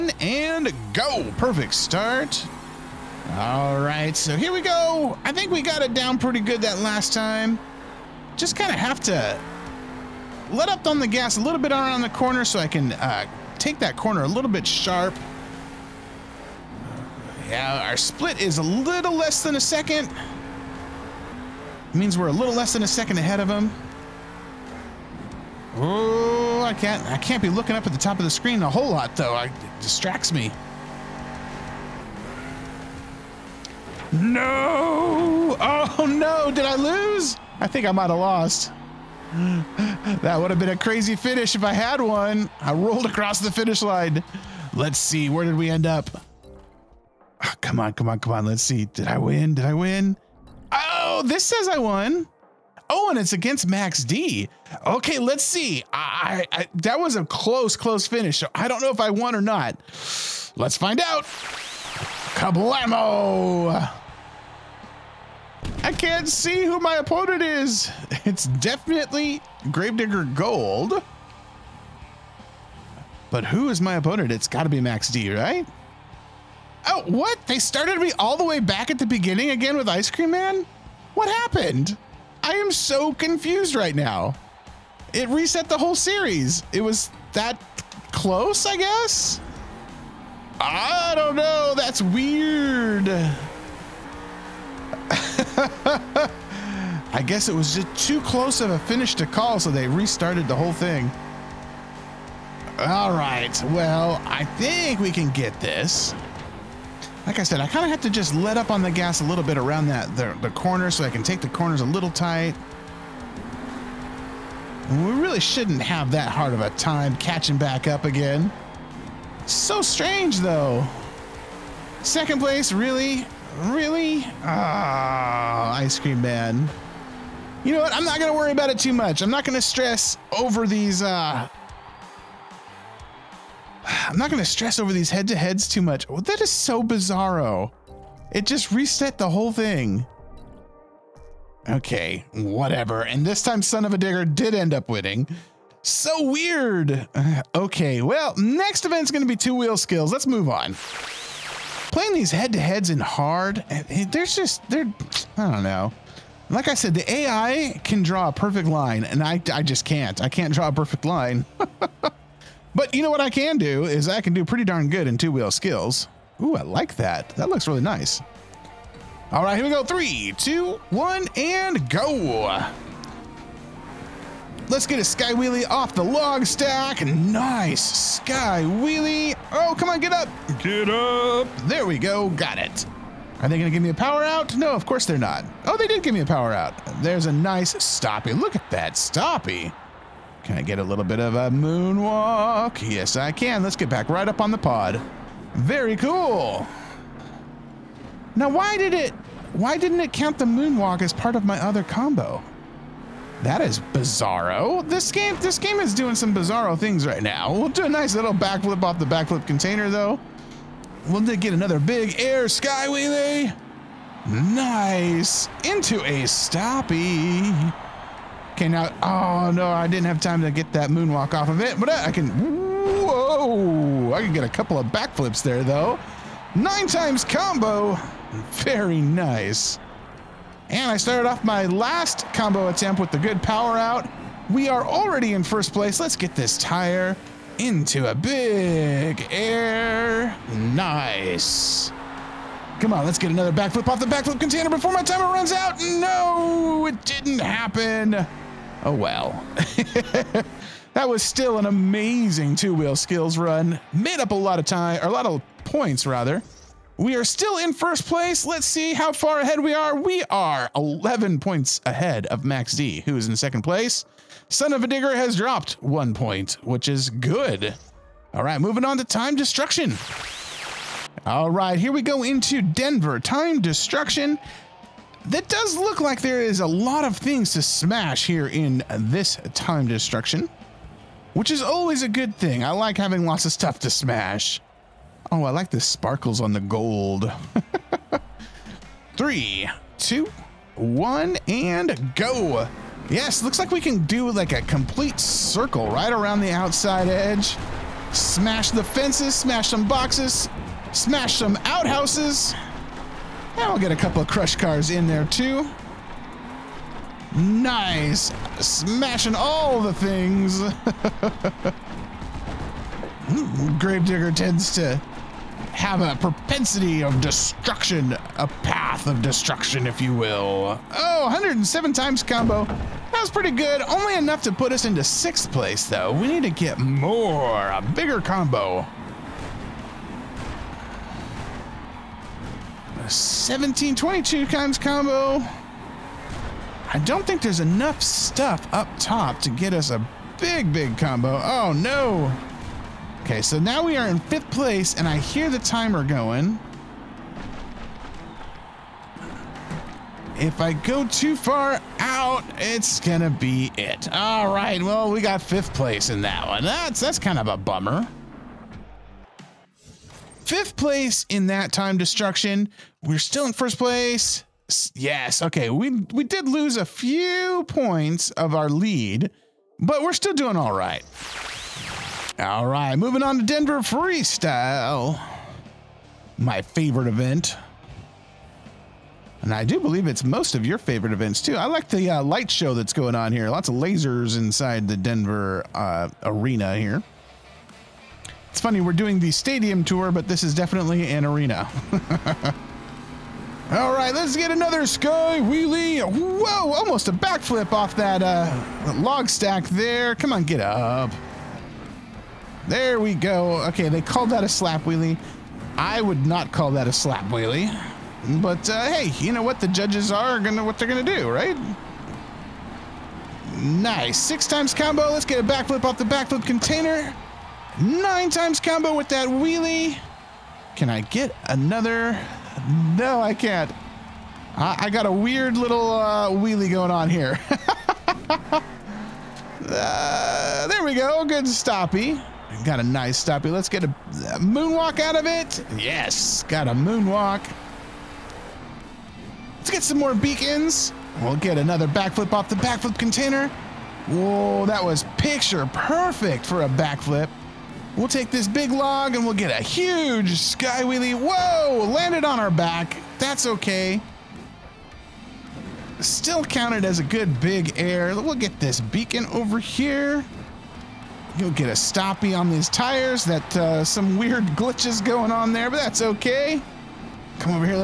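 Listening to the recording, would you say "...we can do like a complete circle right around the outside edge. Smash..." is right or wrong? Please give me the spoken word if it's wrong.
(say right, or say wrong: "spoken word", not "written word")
right.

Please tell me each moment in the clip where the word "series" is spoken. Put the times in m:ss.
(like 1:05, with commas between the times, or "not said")
1:25.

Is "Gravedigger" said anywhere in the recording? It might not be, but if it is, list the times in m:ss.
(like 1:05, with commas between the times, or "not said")
1:09, 5:13.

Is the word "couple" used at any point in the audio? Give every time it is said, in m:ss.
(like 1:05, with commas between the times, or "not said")
3:44, 5:03.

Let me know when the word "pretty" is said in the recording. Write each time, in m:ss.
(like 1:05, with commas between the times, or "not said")
0:06, 2:44, 5:23.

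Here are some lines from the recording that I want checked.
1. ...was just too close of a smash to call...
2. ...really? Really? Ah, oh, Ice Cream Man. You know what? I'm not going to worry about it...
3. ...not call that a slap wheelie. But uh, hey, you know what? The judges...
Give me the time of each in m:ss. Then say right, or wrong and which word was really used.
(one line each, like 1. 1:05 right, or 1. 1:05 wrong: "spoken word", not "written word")
1. 1:37 wrong: "finish", not "smash"
2. 2:02 right
3. 6:46 right.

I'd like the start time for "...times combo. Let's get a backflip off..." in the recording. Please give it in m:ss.
6:54.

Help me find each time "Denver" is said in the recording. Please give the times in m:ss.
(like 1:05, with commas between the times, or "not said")
4:32, 6:13, 6:24.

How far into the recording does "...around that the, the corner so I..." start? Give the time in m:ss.
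1:49.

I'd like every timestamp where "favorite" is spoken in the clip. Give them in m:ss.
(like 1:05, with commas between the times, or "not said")
6:16, 6:20.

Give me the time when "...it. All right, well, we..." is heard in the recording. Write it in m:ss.
5:53.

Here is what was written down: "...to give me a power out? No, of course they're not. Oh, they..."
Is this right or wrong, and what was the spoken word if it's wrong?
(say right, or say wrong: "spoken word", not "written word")
right.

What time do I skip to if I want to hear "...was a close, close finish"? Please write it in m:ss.
0:56.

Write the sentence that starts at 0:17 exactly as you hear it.
Yeah, our split is a little less than a second.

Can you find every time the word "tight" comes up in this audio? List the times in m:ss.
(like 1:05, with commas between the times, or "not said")
1:52.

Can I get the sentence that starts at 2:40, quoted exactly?
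I can't draw a perfect line.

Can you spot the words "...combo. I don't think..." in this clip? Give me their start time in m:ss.
5:34.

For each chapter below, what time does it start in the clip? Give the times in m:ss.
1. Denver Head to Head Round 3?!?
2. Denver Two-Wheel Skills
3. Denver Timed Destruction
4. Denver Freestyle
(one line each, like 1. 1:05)
1. 1:02
2. 2:31
3. 4:30
4. 6:12.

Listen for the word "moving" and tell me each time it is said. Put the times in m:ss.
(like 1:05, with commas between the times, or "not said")
4:28, 6:12.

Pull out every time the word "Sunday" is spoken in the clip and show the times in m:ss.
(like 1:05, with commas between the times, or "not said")
not said.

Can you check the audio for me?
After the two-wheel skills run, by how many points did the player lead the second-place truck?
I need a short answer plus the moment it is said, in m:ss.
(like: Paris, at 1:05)
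11, at 4:20.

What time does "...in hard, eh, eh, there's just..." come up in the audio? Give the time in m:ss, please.
2:32.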